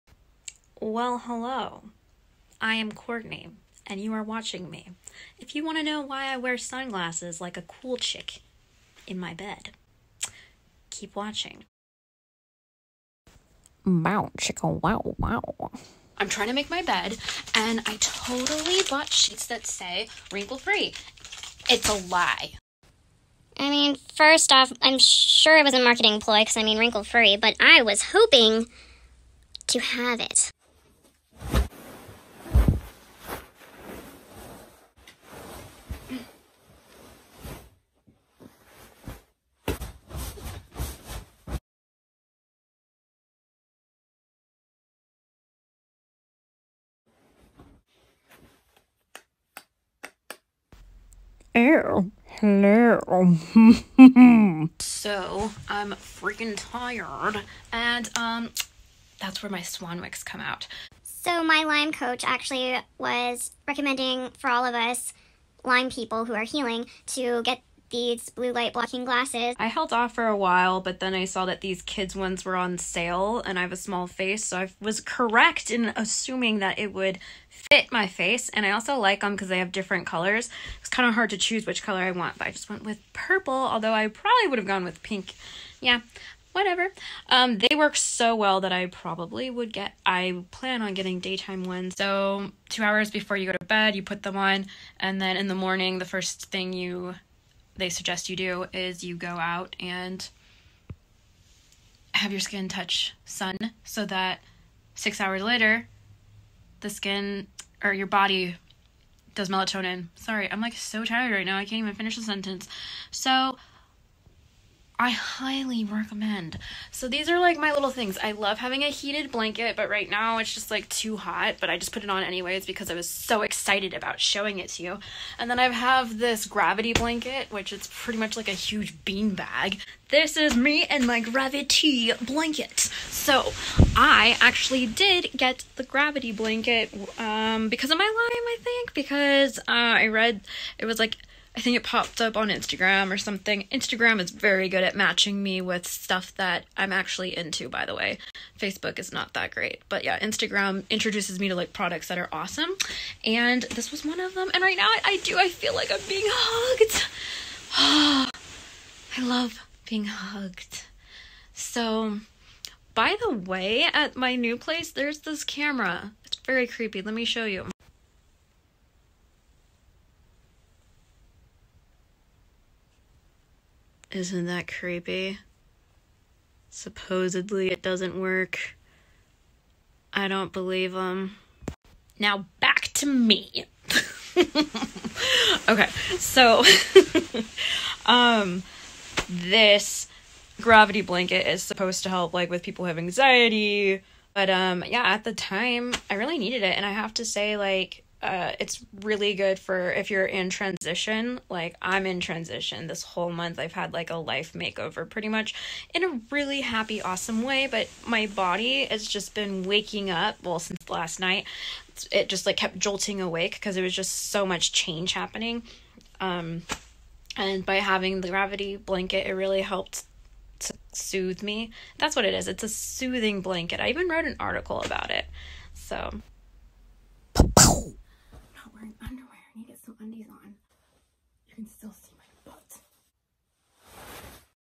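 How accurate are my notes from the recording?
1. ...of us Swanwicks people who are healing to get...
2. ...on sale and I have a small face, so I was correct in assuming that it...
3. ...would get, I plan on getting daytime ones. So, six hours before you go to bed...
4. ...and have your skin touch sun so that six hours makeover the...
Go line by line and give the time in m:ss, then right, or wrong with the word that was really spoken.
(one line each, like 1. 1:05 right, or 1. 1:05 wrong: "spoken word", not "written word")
1. 1:04 wrong: "Lyme", not "Swanwicks"
2. 1:12 right
3. 1:29 wrong: "two", not "six"
4. 1:39 wrong: "later", not "makeover".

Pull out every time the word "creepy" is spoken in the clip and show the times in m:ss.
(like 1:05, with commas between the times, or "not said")
2:46, 2:54.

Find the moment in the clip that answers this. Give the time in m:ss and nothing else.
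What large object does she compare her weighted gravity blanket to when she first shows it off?
2:08.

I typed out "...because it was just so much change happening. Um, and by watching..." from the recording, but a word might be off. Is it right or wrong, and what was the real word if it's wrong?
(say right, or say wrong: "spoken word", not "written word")
wrong: "having", not "watching".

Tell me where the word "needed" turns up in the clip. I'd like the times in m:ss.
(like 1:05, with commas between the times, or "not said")
3:16.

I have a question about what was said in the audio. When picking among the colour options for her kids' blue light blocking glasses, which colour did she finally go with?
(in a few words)
Purple.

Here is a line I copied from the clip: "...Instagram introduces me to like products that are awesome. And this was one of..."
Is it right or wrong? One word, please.
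right.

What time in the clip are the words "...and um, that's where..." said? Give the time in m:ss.
0:57.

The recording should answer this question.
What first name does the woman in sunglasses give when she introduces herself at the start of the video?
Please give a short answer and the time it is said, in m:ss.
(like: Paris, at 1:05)
Courtney, at 0:02.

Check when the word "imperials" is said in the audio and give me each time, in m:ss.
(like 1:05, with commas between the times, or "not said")
not said.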